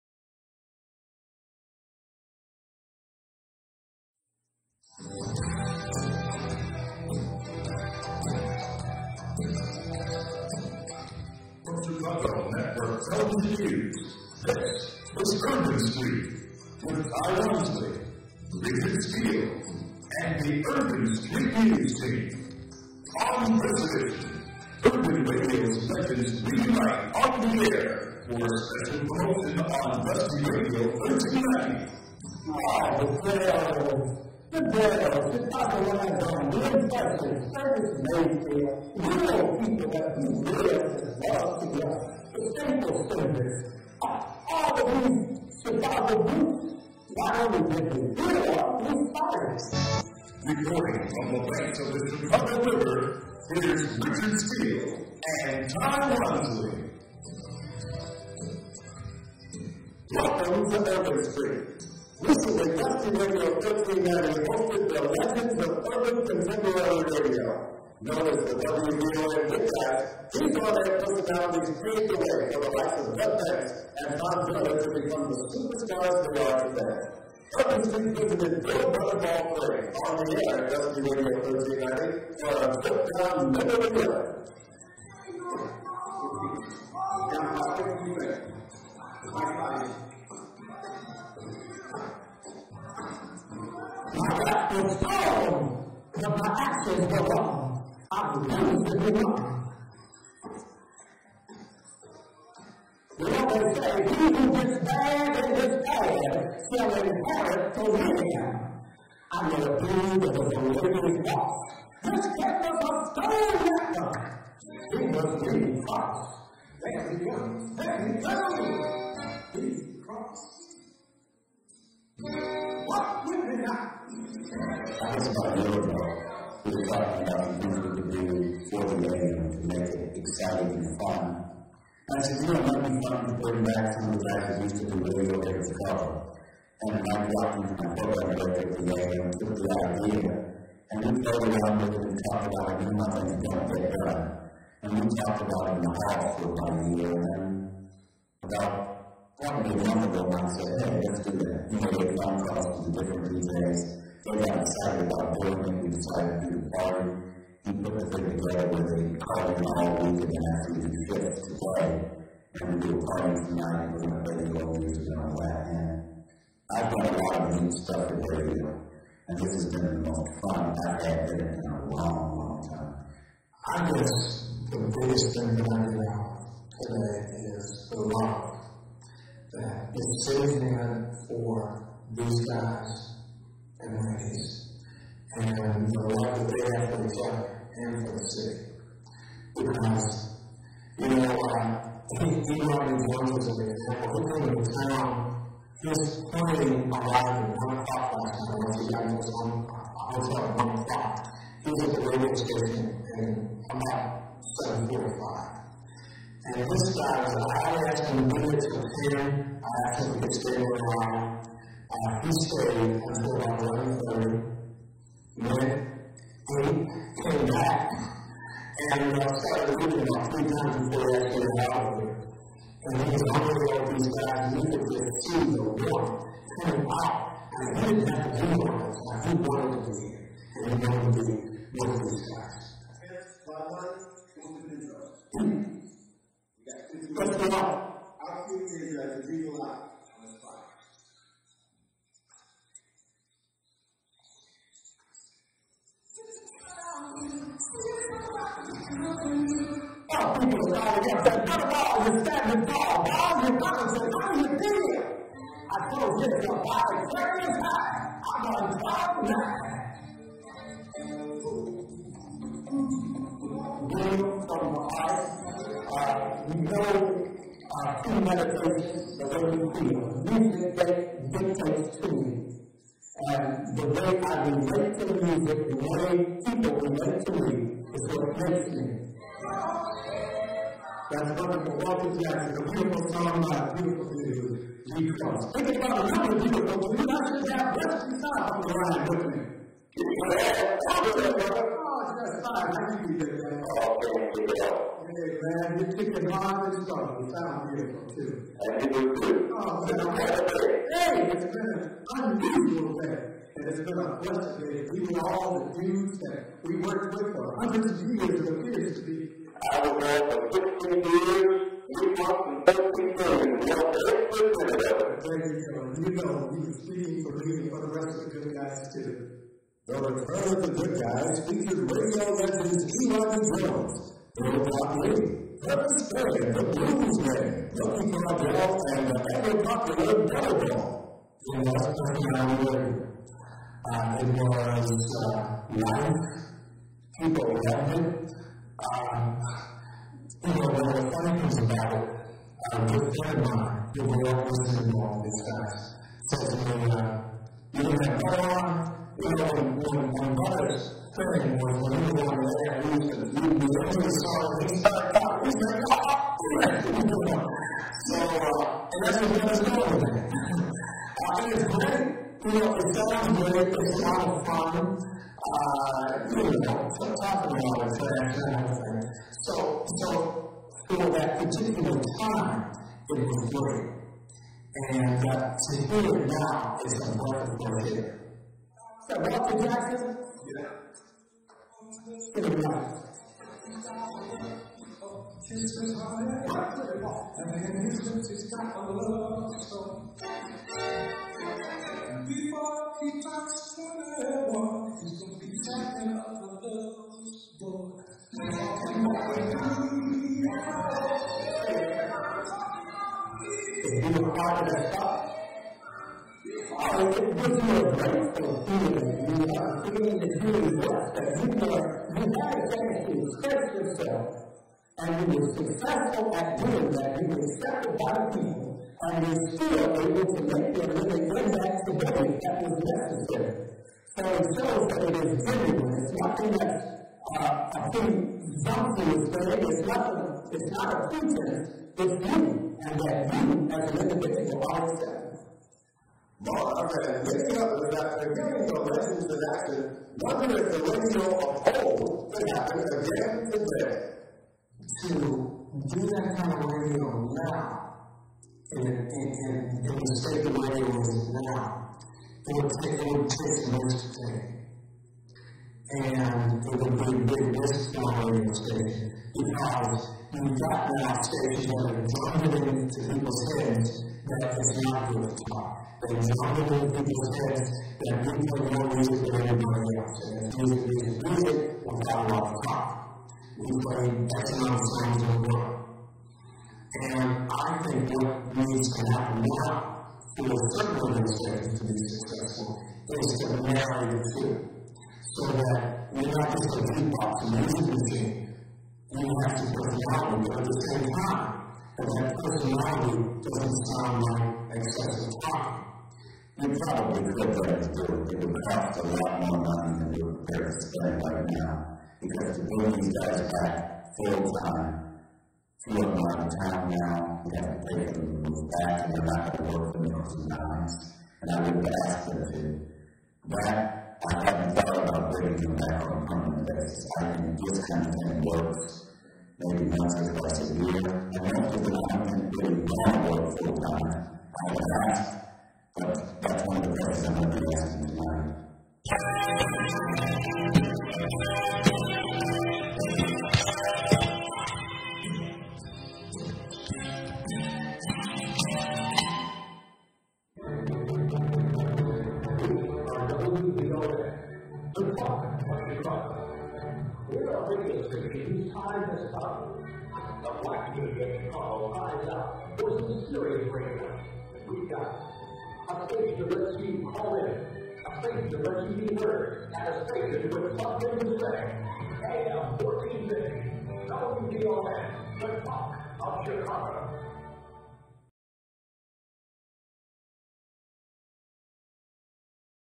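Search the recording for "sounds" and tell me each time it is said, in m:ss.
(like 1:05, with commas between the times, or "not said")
6:02, 8:13.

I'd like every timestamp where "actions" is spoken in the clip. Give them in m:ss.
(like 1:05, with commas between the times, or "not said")
1:36, 7:19.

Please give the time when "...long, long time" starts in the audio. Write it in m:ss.
2:51.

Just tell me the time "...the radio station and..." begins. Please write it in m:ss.
3:21.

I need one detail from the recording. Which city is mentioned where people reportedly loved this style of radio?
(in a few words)
Las Vegas.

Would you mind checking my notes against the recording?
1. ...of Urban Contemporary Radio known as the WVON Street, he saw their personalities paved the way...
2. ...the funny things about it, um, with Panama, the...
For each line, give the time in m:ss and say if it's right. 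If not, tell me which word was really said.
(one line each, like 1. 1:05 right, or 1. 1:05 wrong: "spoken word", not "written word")
1. 1:05 wrong: "Dispatch", not "Street"
2. 5:40 right.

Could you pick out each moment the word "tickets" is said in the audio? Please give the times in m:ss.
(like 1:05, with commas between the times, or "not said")
not said.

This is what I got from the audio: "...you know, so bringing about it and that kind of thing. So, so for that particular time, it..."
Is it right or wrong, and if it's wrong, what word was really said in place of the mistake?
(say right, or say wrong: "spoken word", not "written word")
wrong: "talking", not "bringing".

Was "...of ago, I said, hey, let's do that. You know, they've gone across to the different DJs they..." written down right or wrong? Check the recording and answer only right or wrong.
right.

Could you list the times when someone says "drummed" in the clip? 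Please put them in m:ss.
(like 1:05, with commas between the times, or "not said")
7:42, 7:46.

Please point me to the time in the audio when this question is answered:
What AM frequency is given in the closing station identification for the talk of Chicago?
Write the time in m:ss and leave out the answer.
9:22.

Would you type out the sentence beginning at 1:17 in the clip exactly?
Urban Street visited Bill Brother Ball on the air at Dusty 1390 for a trip down memory lane.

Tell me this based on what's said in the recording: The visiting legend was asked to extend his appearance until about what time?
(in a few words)
11:30.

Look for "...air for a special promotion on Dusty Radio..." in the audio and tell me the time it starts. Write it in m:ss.
0:27.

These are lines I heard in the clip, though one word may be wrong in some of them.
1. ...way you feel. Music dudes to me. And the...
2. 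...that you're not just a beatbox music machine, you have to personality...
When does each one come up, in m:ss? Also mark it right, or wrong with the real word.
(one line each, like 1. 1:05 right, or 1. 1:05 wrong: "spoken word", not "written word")
1. 4:29 wrong: "dictates", not "dudes"
2. 8:05 right.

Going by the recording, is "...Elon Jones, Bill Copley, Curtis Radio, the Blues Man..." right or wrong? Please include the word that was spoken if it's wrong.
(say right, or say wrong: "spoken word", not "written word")
wrong: "Perry", not "Radio".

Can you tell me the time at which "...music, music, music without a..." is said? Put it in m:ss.
7:50.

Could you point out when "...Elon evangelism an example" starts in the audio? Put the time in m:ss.
3:12.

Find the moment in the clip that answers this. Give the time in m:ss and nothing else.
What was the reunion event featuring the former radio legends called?
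5:19.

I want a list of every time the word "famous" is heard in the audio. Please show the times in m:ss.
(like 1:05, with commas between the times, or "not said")
not said.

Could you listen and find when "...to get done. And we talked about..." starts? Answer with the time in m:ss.
2:23.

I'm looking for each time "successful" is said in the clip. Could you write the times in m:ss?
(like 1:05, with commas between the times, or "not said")
6:55, 8:02.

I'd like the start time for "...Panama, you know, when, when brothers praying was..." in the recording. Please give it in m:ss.
5:48.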